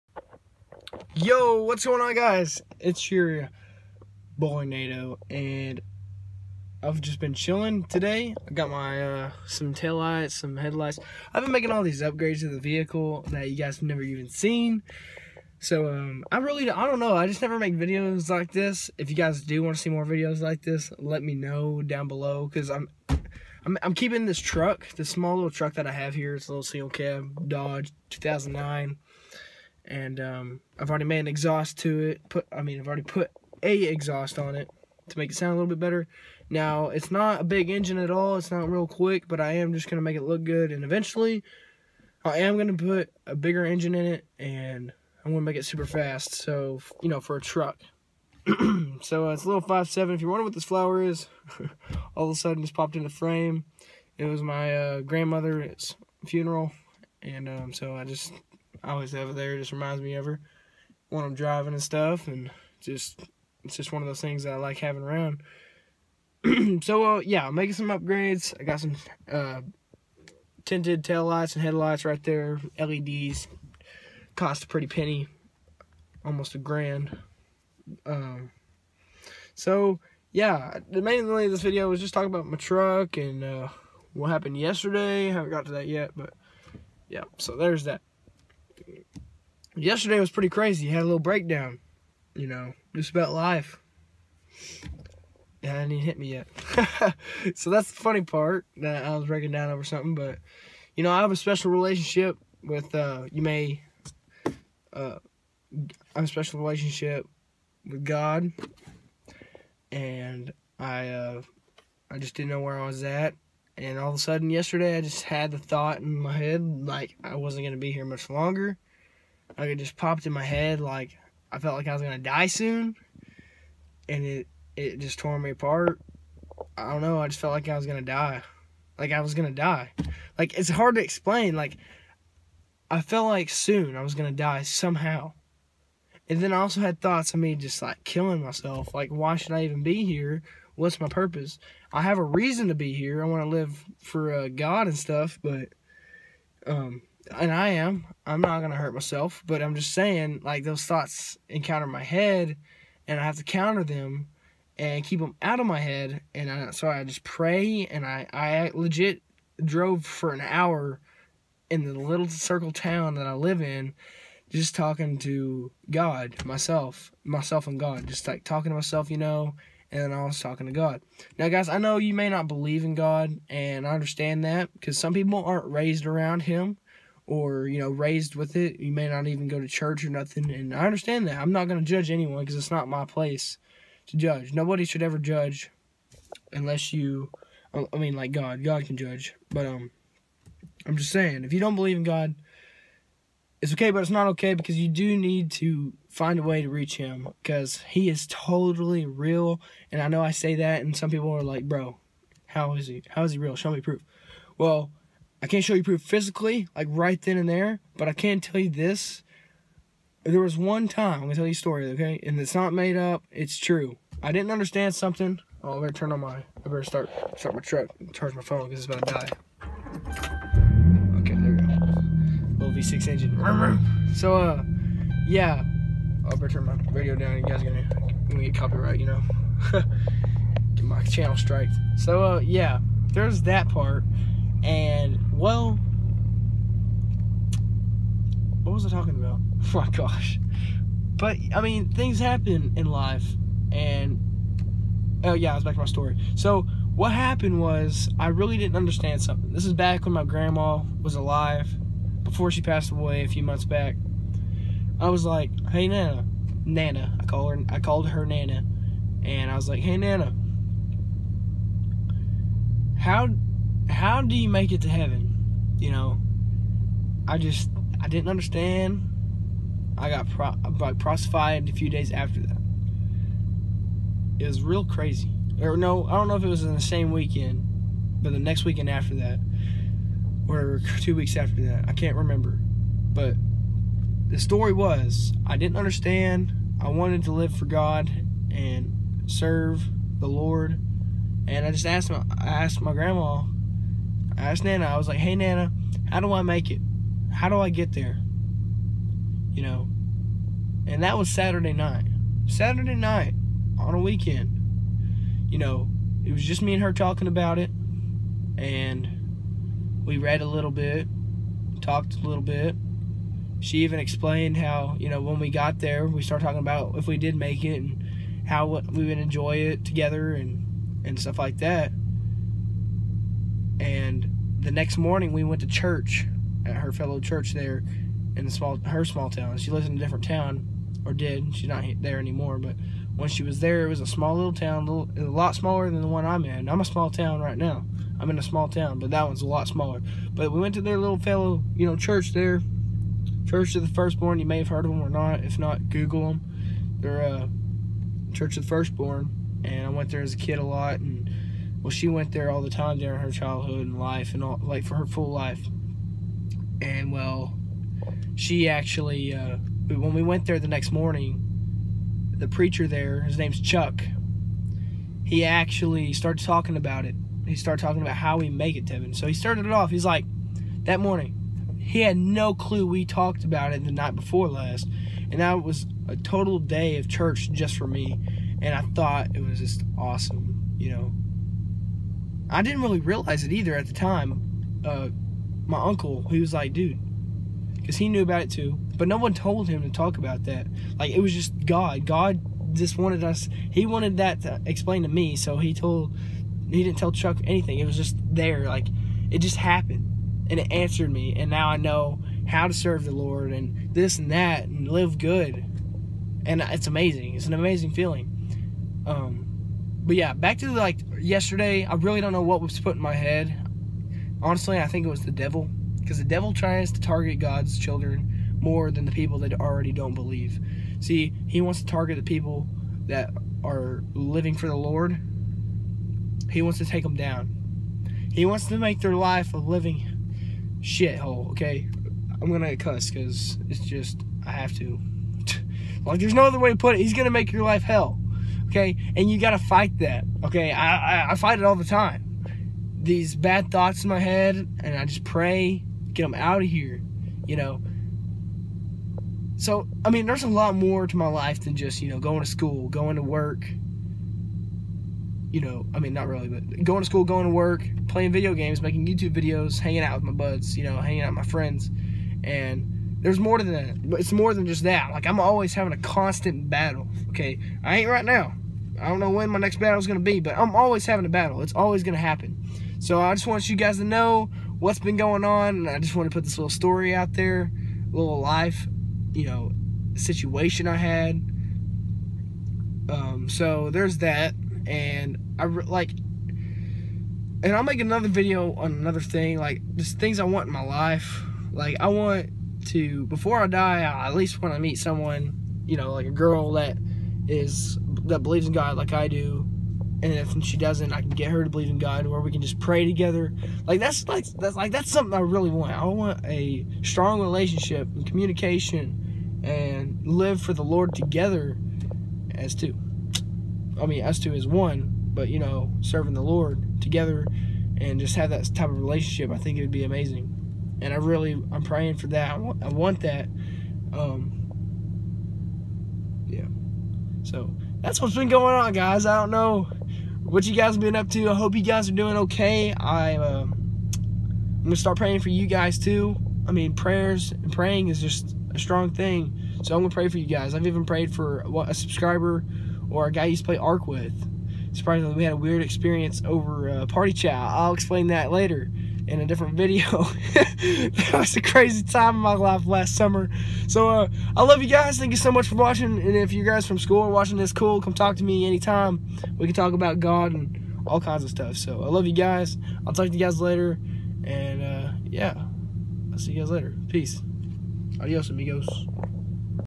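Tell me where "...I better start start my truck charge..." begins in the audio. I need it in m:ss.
3:36.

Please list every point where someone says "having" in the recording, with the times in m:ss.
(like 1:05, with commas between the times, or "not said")
1:04, 7:45, 7:51.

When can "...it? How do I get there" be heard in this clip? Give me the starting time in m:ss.
4:56.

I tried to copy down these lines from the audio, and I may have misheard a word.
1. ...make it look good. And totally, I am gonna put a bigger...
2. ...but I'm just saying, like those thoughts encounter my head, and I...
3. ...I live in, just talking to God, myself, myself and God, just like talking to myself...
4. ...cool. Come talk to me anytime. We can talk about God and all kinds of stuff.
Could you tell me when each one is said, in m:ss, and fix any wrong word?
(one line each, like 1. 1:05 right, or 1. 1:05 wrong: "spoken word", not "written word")
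1. 0:40 wrong: "eventually", not "totally"
2. 2:29 right
3. 2:43 right
4. 9:17 right.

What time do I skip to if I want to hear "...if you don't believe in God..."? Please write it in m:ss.
3:11.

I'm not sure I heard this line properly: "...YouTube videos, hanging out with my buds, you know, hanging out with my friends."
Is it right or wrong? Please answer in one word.
right.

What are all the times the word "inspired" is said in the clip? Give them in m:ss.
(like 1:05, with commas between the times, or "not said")
not said.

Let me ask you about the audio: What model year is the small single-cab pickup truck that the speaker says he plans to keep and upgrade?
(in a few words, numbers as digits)
2009.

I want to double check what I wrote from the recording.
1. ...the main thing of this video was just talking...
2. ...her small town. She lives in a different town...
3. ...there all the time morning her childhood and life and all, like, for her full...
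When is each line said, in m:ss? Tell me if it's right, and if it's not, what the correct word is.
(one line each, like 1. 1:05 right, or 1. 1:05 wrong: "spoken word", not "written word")
1. 1:20 right
2. 5:28 right
3. 5:52 wrong: "during", not "morning".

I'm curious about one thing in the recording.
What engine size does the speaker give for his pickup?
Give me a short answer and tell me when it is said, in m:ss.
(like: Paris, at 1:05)
5.7, at 0:49.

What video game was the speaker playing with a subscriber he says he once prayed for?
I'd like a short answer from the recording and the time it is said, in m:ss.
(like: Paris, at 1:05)
ARK, at 9:03.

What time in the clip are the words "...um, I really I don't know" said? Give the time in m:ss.
0:15.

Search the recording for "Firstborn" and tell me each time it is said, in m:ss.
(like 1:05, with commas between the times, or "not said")
5:43, 5:48.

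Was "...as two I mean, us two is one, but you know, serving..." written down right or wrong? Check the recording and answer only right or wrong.
right.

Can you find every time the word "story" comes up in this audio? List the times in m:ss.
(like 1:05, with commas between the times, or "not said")
3:31, 4:05, 4:44, 7:56.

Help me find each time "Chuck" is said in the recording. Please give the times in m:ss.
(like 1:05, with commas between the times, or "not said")
6:03, 6:37.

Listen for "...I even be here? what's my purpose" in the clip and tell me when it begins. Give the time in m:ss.
2:19.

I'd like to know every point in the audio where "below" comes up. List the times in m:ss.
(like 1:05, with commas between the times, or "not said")
0:22.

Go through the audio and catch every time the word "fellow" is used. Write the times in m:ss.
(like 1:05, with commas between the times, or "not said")
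5:26, 5:41.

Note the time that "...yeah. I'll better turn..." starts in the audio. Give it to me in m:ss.
3:45.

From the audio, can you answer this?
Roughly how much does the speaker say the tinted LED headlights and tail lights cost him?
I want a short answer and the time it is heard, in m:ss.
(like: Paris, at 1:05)
Almost a grand, at 1:16.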